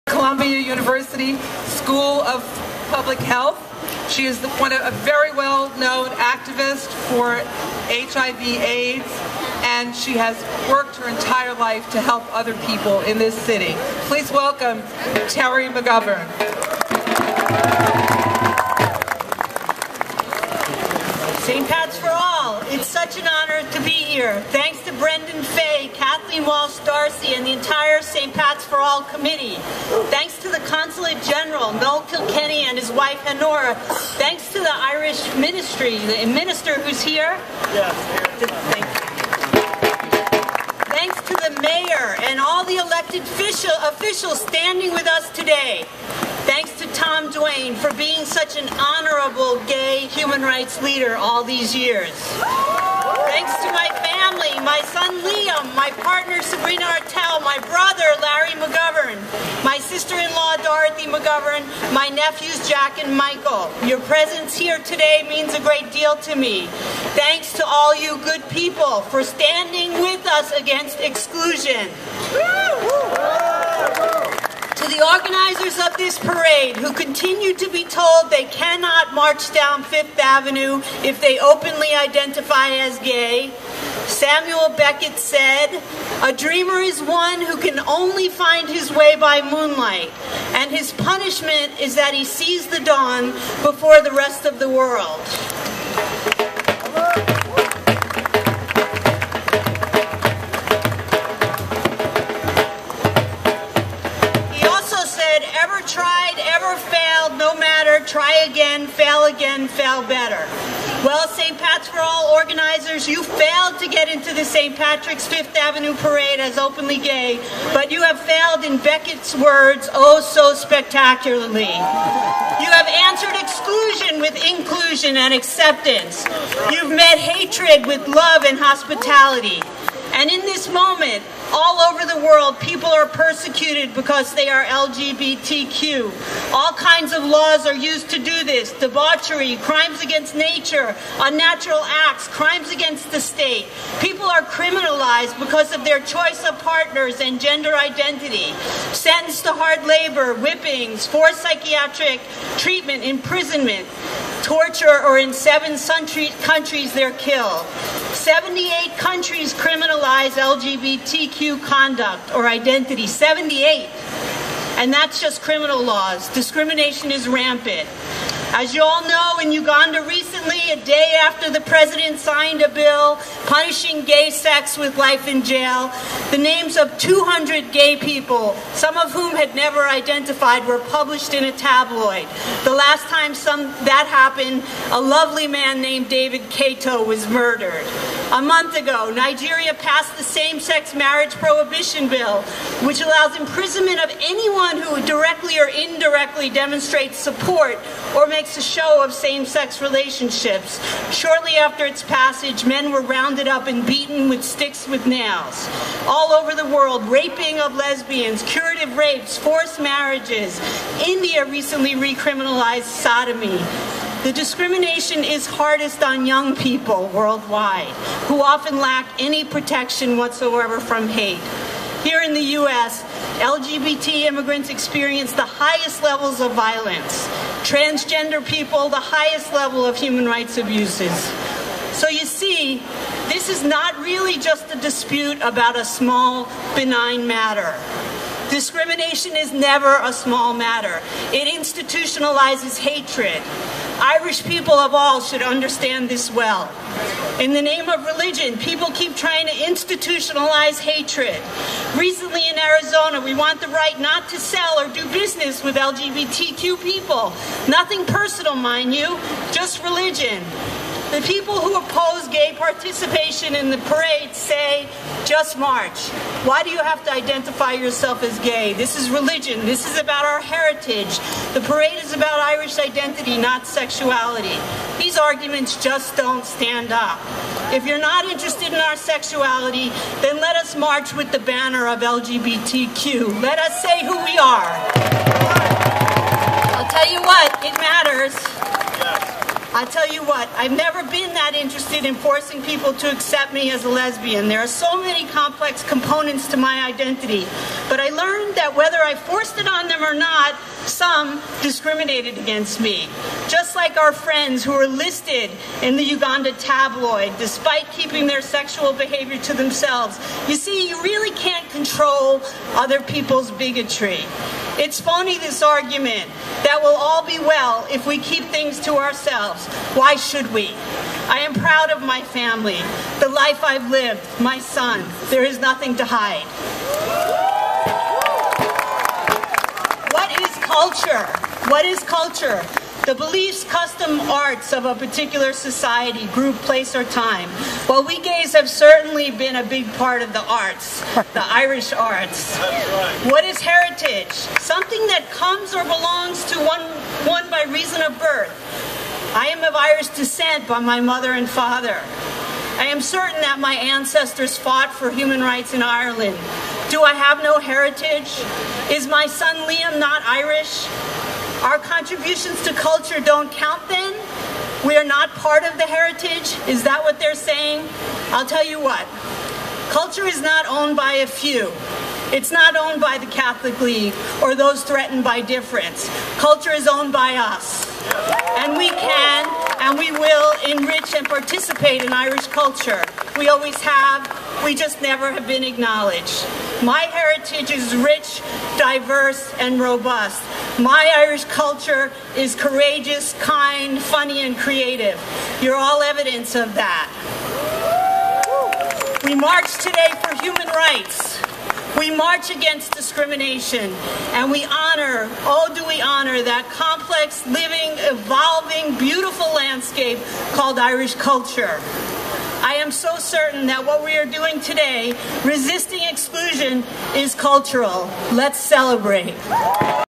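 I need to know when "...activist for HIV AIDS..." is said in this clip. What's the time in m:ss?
0:06.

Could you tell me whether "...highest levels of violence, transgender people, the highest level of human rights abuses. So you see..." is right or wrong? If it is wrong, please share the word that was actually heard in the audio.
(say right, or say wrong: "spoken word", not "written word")
right.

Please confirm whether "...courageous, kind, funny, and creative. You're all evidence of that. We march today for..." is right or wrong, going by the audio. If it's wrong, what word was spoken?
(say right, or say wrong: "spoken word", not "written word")
right.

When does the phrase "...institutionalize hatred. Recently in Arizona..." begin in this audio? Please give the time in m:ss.
4:09.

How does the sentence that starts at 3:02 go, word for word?
The last time some, that happened, a lovely man named David Kato was murdered.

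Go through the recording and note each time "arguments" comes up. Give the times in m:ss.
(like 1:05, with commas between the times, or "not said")
4:35, 5:15.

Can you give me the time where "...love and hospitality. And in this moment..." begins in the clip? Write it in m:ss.
2:08.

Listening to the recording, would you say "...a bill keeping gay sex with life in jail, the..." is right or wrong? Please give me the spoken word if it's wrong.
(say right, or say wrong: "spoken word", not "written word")
wrong: "punishing", not "keeping".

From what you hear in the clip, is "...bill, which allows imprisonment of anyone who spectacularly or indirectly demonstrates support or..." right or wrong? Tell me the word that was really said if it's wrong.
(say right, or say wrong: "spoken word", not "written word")
wrong: "directly", not "spectacularly".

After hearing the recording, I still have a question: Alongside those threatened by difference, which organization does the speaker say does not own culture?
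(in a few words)
Catholic League.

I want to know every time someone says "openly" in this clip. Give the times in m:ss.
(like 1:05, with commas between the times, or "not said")
1:21, 1:56.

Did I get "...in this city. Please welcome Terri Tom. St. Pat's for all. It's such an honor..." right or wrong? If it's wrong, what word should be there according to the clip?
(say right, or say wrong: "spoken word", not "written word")
wrong: "McGovern", not "Tom".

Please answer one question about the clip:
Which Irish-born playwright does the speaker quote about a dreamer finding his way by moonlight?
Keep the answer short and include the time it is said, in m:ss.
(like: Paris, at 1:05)
Samuel Beckett, at 1:24.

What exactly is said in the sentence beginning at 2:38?
78 countries criminalize LGBTQ conduct or identity.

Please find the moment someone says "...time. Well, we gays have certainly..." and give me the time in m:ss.
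5:37.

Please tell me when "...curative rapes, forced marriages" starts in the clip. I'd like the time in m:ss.
3:28.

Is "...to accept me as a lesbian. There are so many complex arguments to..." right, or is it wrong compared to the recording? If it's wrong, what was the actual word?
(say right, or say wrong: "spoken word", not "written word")
wrong: "components", not "arguments".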